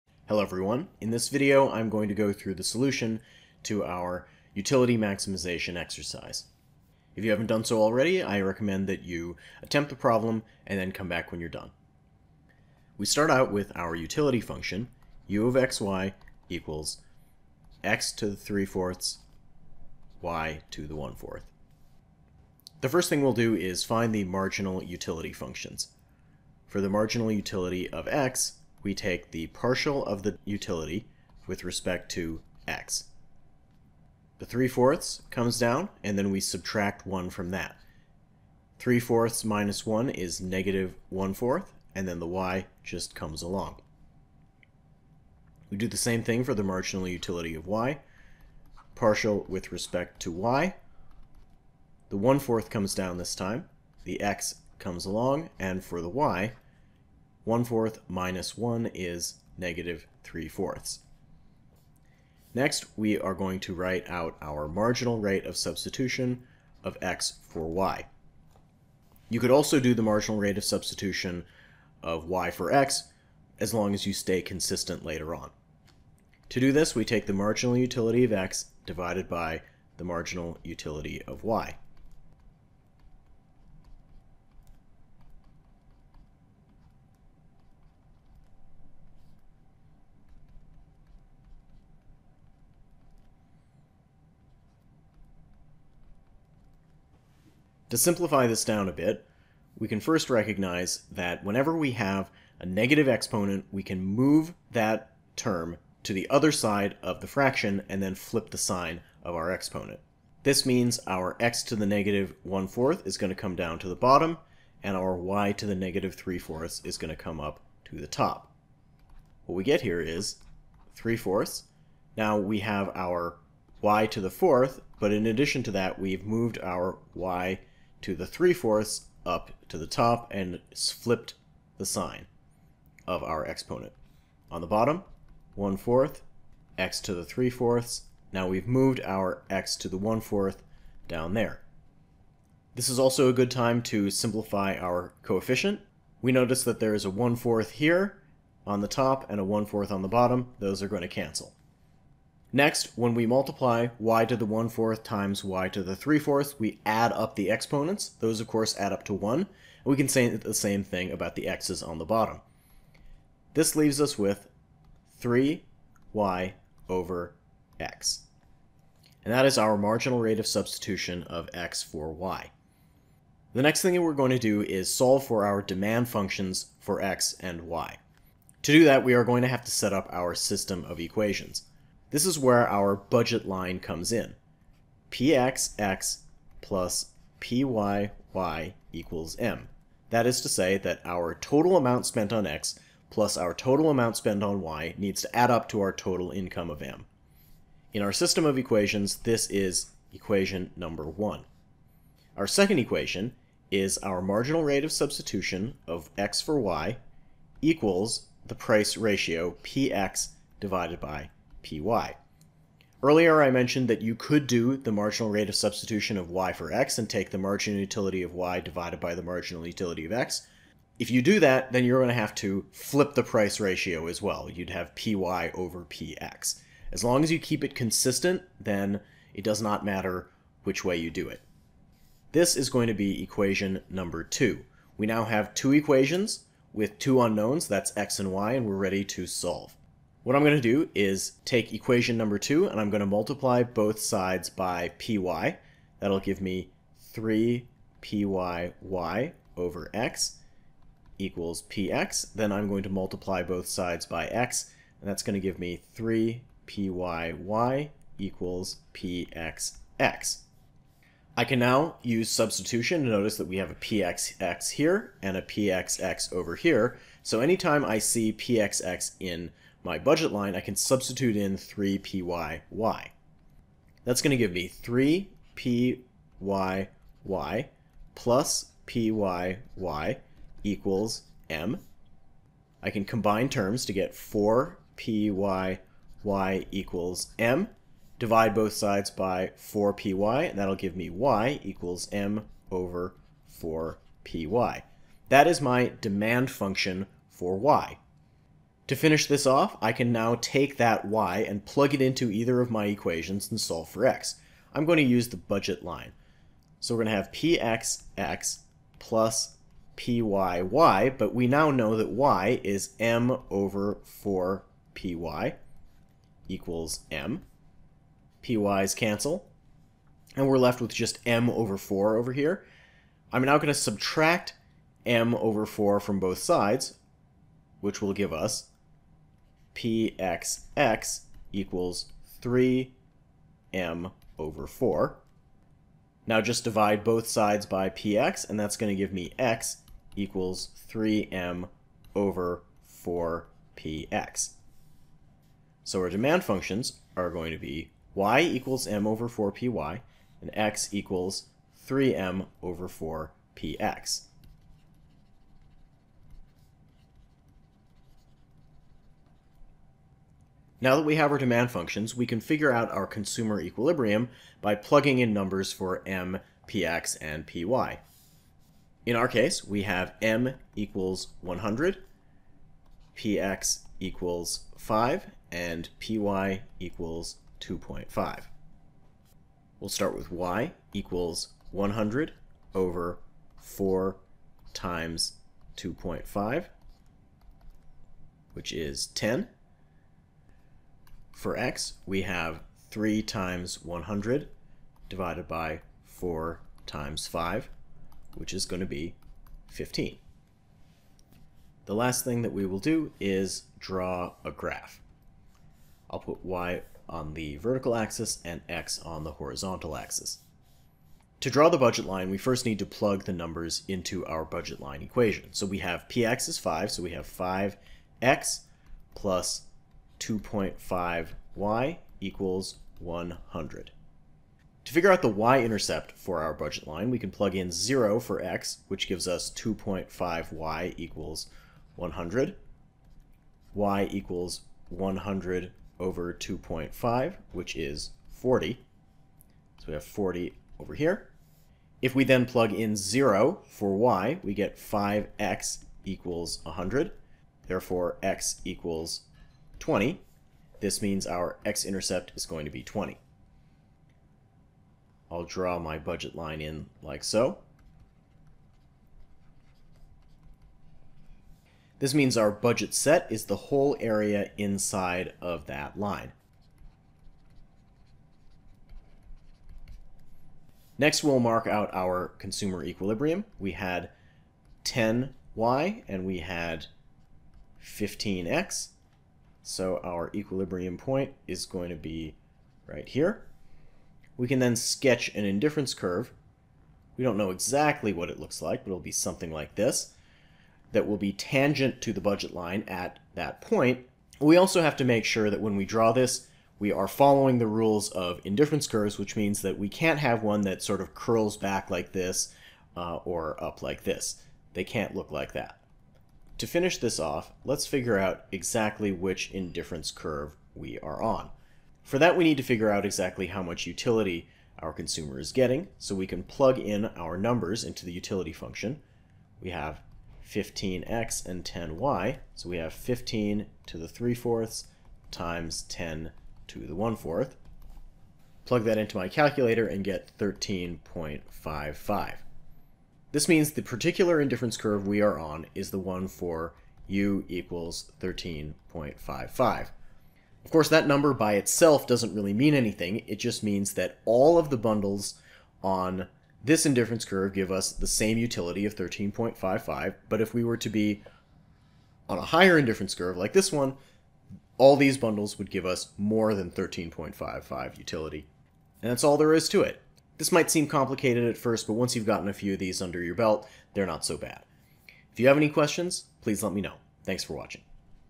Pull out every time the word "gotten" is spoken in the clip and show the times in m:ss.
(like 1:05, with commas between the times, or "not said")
9:22.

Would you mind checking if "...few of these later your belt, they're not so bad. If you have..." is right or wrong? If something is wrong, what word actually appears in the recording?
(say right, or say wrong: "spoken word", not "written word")
wrong: "under", not "later".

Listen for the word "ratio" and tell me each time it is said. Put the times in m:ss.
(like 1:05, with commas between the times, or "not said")
3:28, 3:43.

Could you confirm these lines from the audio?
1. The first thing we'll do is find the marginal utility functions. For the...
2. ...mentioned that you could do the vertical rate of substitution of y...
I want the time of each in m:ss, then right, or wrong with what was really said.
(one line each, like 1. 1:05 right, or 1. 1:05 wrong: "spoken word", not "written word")
1. 0:22 right
2. 3:33 wrong: "marginal", not "vertical".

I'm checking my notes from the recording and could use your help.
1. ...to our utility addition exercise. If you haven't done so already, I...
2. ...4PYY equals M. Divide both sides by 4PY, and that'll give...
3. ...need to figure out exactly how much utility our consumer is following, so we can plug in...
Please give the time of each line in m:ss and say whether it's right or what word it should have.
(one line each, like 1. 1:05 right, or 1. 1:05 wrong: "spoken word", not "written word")
1. 0:03 wrong: "maximization", not "addition"
2. 4:44 right
3. 8:32 wrong: "getting", not "following".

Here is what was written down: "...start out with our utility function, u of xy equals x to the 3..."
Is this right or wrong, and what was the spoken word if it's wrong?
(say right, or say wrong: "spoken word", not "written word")
right.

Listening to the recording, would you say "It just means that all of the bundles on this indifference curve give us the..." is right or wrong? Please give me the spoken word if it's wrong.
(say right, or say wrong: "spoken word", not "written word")
right.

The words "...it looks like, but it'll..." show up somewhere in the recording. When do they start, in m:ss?
8:08.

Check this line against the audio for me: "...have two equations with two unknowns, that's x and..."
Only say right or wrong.
right.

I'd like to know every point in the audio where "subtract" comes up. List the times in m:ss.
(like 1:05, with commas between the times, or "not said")
0:36, 5:23.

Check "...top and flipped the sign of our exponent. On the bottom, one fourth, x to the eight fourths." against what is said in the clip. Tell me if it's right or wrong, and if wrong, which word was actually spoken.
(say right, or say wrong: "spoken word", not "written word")
wrong: "three", not "eight".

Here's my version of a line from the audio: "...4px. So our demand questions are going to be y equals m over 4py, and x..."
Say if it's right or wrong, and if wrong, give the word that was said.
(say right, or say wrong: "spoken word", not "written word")
wrong: "functions", not "questions".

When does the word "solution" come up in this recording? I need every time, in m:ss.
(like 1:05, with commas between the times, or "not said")
0:02.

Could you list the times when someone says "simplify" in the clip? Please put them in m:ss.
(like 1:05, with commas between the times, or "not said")
1:37, 2:24.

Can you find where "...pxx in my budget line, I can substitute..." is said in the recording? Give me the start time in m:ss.
4:28.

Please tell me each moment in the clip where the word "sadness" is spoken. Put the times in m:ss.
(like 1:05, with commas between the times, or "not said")
not said.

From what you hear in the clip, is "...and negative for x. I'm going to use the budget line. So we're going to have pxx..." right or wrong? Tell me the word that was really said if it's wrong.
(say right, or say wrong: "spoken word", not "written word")
wrong: "solve", not "negative".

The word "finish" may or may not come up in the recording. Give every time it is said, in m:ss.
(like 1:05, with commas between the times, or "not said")
4:58, 8:26.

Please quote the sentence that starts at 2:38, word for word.
Those, of course, add up to 1.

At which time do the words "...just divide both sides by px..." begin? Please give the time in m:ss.
5:36.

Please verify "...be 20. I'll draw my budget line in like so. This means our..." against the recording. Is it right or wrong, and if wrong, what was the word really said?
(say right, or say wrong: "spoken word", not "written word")
right.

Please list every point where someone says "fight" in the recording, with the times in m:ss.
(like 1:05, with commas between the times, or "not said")
not said.